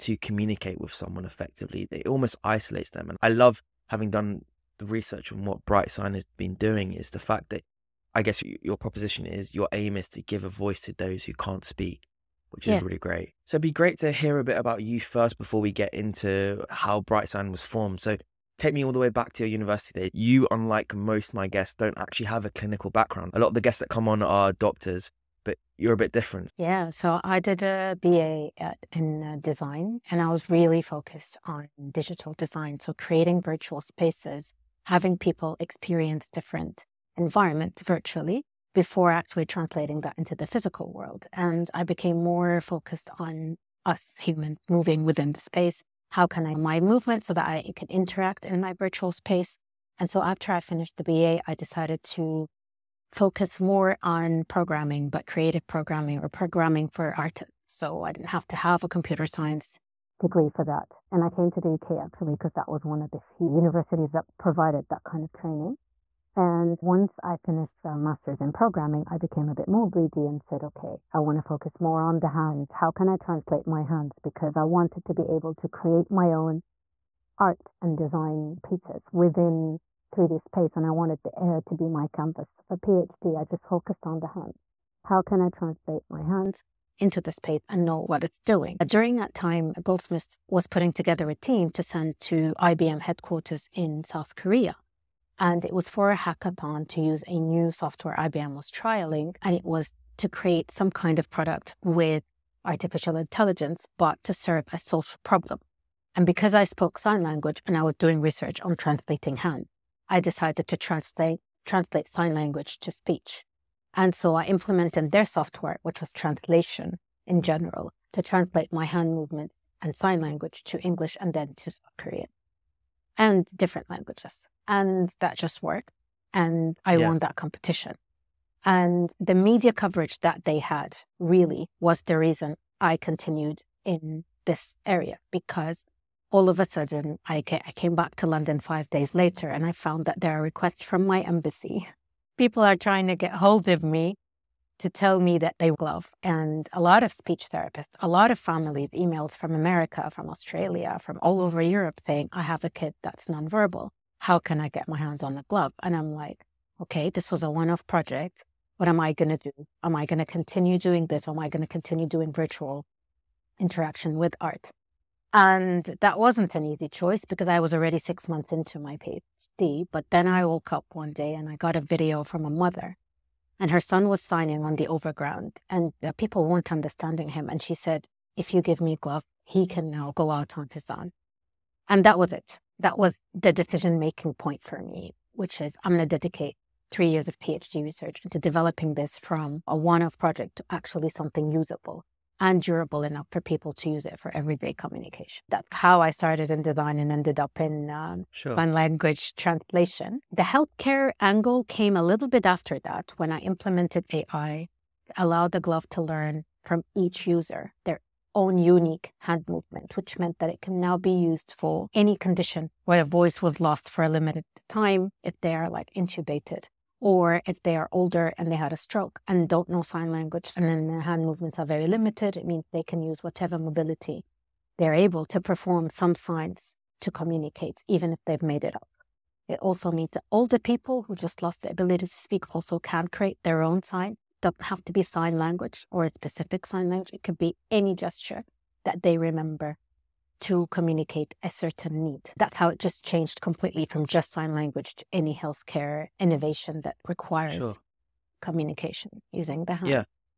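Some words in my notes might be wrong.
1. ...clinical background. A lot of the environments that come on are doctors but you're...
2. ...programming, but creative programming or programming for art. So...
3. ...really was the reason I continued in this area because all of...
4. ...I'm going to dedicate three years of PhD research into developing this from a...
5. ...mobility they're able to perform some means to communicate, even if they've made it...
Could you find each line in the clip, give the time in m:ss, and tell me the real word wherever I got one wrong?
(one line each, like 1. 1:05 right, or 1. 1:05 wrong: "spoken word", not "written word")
1. 0:22 wrong: "guests", not "environments"
2. 0:54 right
3. 2:11 right
4. 3:05 right
5. 3:43 wrong: "signs", not "means".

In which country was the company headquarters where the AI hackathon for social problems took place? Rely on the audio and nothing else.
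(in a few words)
South Korea.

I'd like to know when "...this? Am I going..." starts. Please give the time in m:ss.
2:41.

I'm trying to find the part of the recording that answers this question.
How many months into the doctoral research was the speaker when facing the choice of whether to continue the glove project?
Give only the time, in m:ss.
2:47.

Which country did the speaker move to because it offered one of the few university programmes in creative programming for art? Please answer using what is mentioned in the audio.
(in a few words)
UK.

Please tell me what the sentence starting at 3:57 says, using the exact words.
It could be any gesture that they remember to communicate a certain need.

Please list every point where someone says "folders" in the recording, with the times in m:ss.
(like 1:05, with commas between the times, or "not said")
not said.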